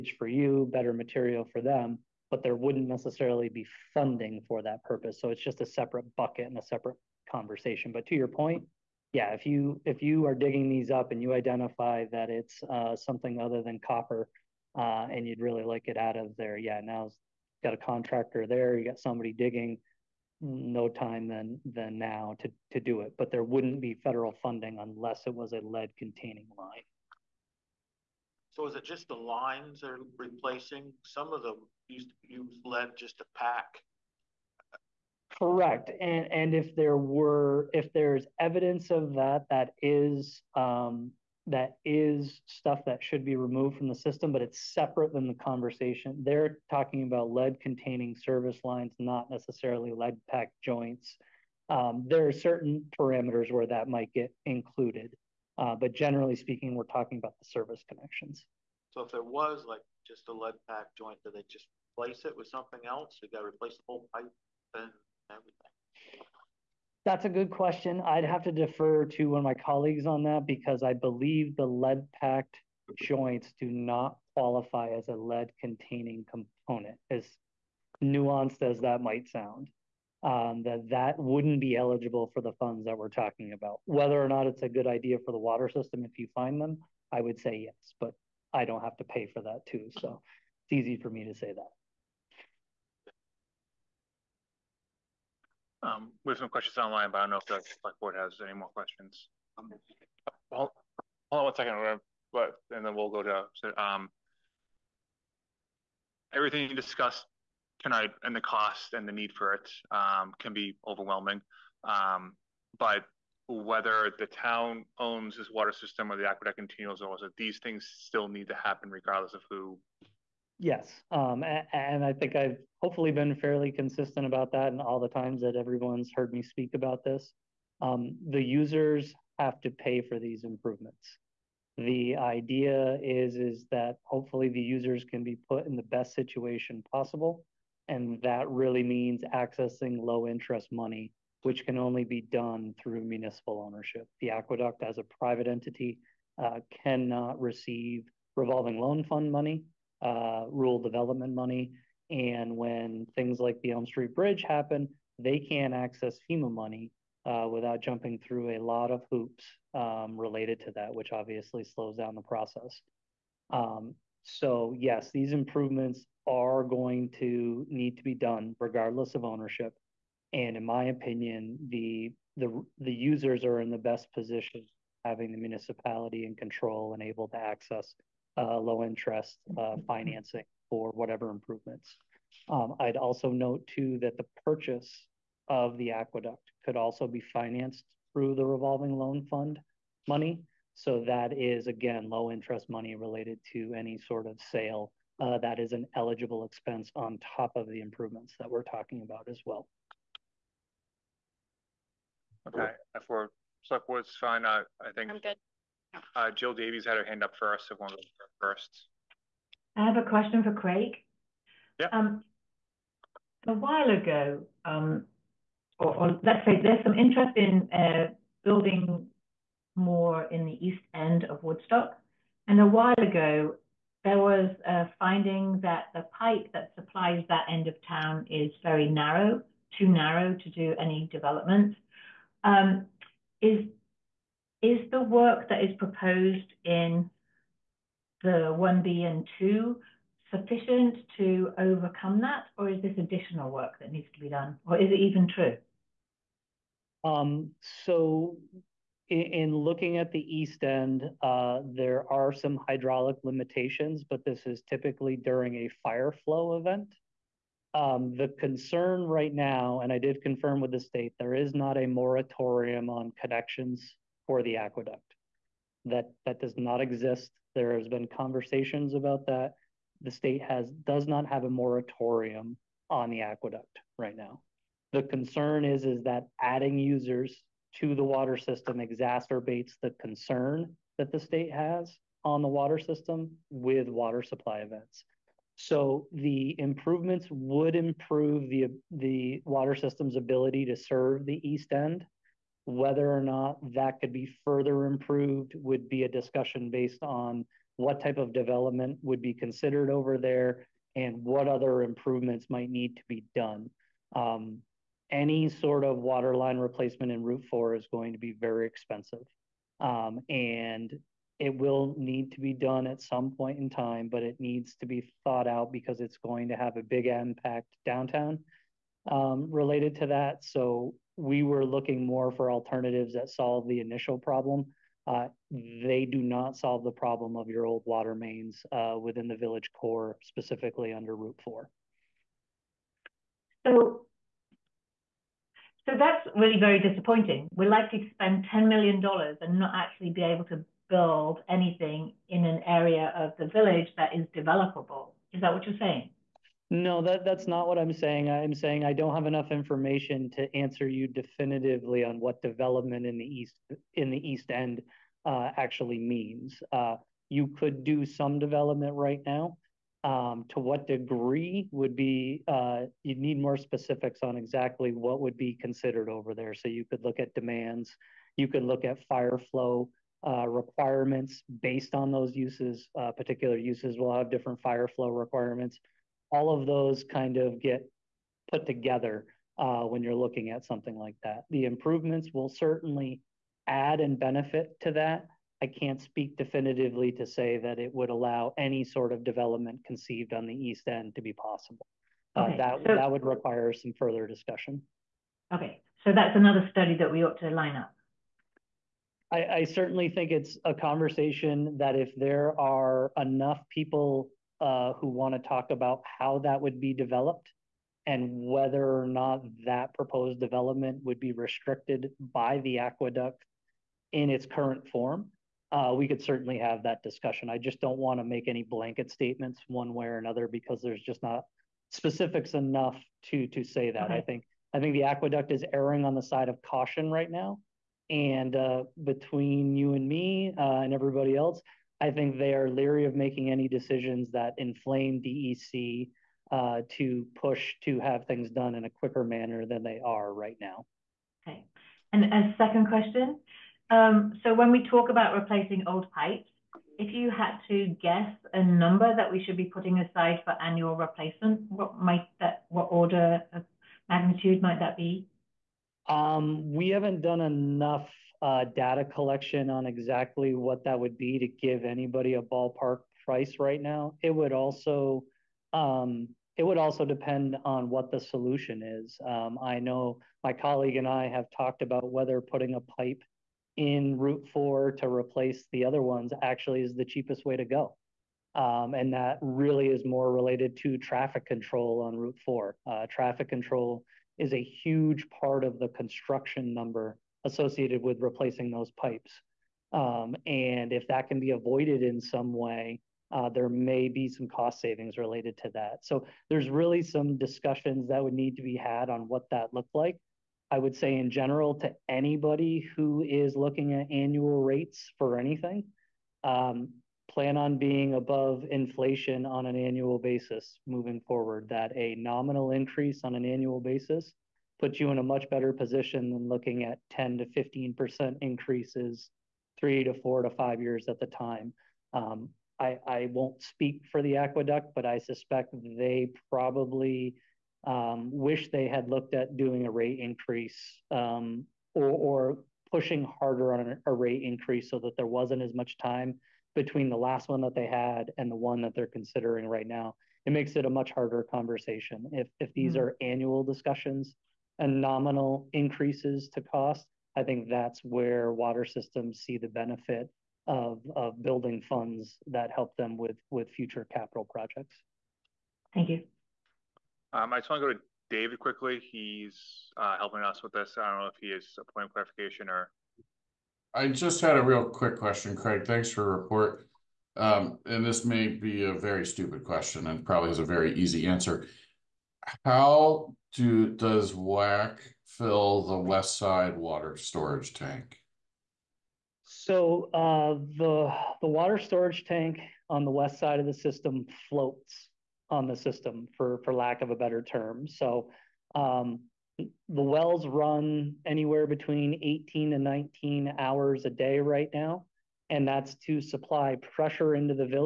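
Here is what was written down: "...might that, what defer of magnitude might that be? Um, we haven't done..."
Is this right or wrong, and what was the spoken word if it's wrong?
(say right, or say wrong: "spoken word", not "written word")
wrong: "order", not "defer".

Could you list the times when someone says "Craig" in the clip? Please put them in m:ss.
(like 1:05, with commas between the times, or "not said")
3:30, 9:25.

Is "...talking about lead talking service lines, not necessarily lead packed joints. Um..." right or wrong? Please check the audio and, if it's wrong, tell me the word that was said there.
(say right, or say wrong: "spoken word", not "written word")
wrong: "containing", not "talking".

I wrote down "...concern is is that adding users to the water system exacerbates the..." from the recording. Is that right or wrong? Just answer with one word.
right.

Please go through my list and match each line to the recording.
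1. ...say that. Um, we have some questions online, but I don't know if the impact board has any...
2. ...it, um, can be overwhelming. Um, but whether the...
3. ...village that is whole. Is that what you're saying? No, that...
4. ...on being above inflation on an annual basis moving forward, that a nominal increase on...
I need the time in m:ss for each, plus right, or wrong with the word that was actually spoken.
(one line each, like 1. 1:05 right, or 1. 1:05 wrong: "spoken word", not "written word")
1. 1:31 wrong: "select", not "impact"
2. 1:49 right
3. 5:43 wrong: "developable", not "whole"
4. 8:27 right.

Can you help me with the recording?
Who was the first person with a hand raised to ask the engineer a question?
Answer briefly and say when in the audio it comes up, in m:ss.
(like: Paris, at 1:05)
Jill Davies, at 3:26.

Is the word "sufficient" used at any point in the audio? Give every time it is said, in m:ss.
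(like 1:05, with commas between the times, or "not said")
4:00.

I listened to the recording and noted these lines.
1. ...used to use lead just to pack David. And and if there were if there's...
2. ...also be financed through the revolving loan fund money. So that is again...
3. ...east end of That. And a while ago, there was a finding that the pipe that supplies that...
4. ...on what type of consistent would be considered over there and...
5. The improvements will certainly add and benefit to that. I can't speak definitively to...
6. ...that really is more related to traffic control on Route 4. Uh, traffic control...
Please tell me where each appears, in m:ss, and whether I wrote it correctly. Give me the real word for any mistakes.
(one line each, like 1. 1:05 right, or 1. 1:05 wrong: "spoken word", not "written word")
1. 0:31 wrong: "Correct", not "David"
2. 3:06 right
3. 3:40 wrong: "Woodstock", not "That"
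4. 4:57 wrong: "development", not "consistent"
5. 6:21 right
6. 7:59 right.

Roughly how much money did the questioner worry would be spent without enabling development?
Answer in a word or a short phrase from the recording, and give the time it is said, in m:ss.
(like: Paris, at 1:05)
$10 million, at 5:38.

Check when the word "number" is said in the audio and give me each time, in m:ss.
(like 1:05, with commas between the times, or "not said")
7:28, 8:06.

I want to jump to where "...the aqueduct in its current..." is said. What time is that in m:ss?
6:52.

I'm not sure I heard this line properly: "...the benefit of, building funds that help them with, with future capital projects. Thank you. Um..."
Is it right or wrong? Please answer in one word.
right.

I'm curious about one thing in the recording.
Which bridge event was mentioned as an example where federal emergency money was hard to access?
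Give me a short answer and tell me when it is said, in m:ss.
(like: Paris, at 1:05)
Elm Street Bridge, at 2:33.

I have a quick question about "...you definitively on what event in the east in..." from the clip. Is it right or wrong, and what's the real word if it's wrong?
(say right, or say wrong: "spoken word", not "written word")
wrong: "development", not "event".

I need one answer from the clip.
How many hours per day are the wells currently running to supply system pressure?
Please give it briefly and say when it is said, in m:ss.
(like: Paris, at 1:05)
18 to 19, at 9:52.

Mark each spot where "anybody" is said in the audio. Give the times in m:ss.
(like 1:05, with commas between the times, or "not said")
7:41, 8:22.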